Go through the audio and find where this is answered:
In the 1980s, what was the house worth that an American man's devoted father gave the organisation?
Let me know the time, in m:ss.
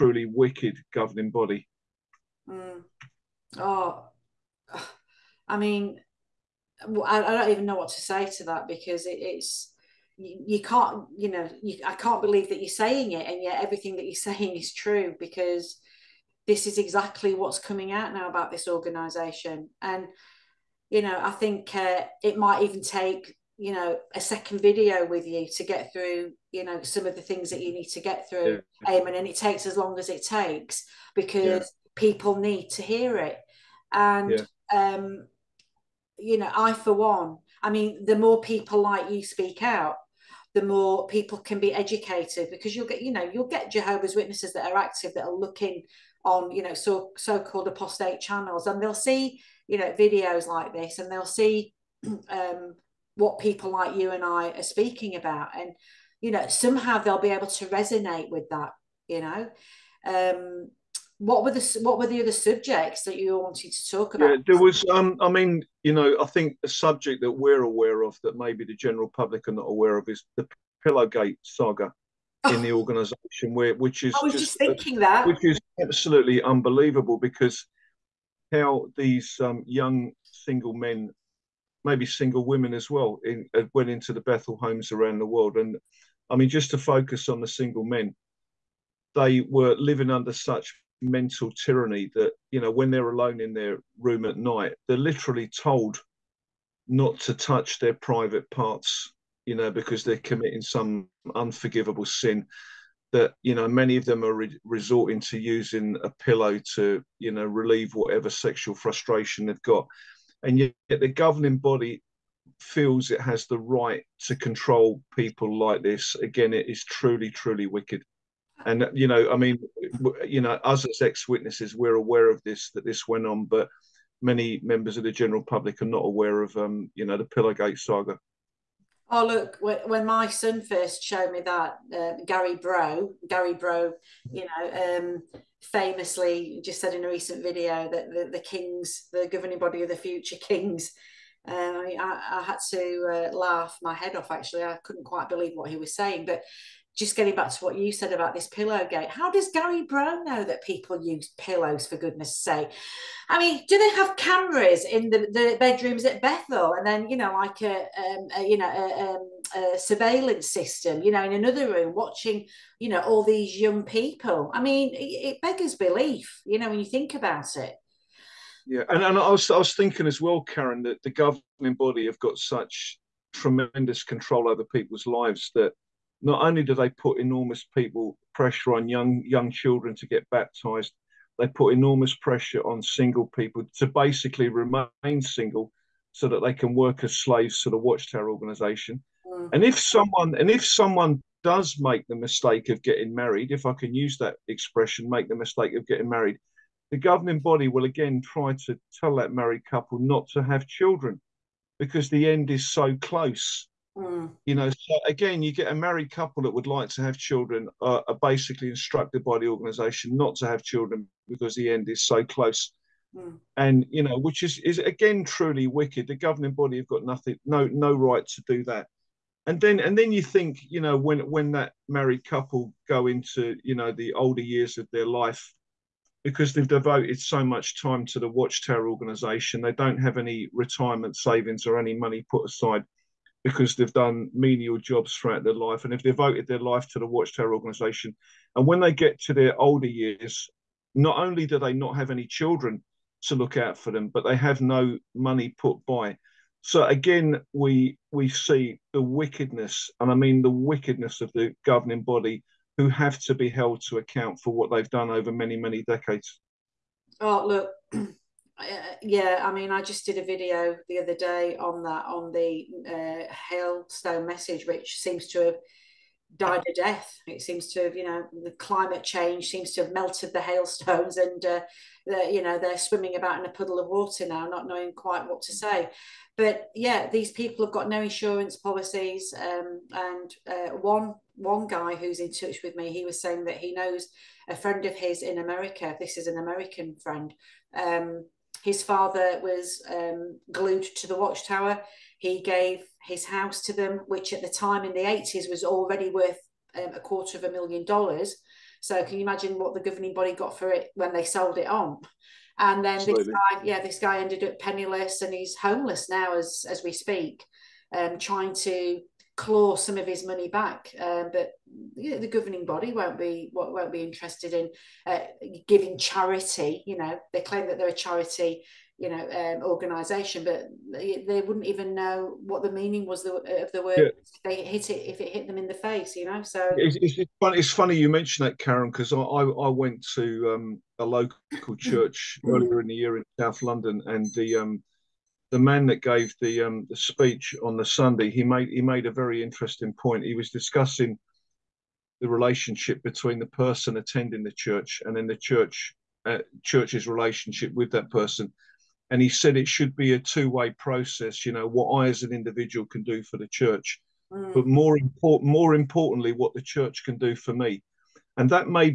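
4:56.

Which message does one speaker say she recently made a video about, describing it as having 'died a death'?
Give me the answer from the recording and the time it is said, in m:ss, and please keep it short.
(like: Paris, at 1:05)
hailstone message, at 4:23.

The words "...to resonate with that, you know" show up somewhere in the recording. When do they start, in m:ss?
0:57.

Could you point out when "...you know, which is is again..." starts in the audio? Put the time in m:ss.
3:33.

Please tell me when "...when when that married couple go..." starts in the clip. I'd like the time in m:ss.
3:40.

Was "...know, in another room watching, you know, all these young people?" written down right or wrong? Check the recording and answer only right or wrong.
right.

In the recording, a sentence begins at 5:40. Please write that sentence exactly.
He was discussing the relationship between the person attending the church and then the church uh, church's relationship with that person.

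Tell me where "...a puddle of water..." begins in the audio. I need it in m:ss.
4:33.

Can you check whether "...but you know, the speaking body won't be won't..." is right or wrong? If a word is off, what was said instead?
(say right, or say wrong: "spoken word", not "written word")
wrong: "governing", not "speaking".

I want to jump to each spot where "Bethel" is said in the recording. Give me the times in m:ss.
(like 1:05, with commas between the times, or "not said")
1:24, 2:36.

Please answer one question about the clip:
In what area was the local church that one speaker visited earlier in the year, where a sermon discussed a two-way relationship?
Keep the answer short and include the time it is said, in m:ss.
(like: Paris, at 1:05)
South London, at 5:33.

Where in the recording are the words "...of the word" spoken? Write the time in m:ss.
5:23.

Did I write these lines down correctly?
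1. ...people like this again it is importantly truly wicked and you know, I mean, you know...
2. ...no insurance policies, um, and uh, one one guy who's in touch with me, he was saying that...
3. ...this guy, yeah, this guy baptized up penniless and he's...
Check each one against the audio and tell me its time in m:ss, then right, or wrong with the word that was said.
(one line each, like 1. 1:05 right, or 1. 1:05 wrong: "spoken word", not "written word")
1. 1:55 wrong: "truly", not "importantly"
2. 4:37 right
3. 5:03 wrong: "ended", not "baptized".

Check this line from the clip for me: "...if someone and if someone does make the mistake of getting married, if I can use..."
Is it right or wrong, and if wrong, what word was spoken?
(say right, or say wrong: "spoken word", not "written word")
right.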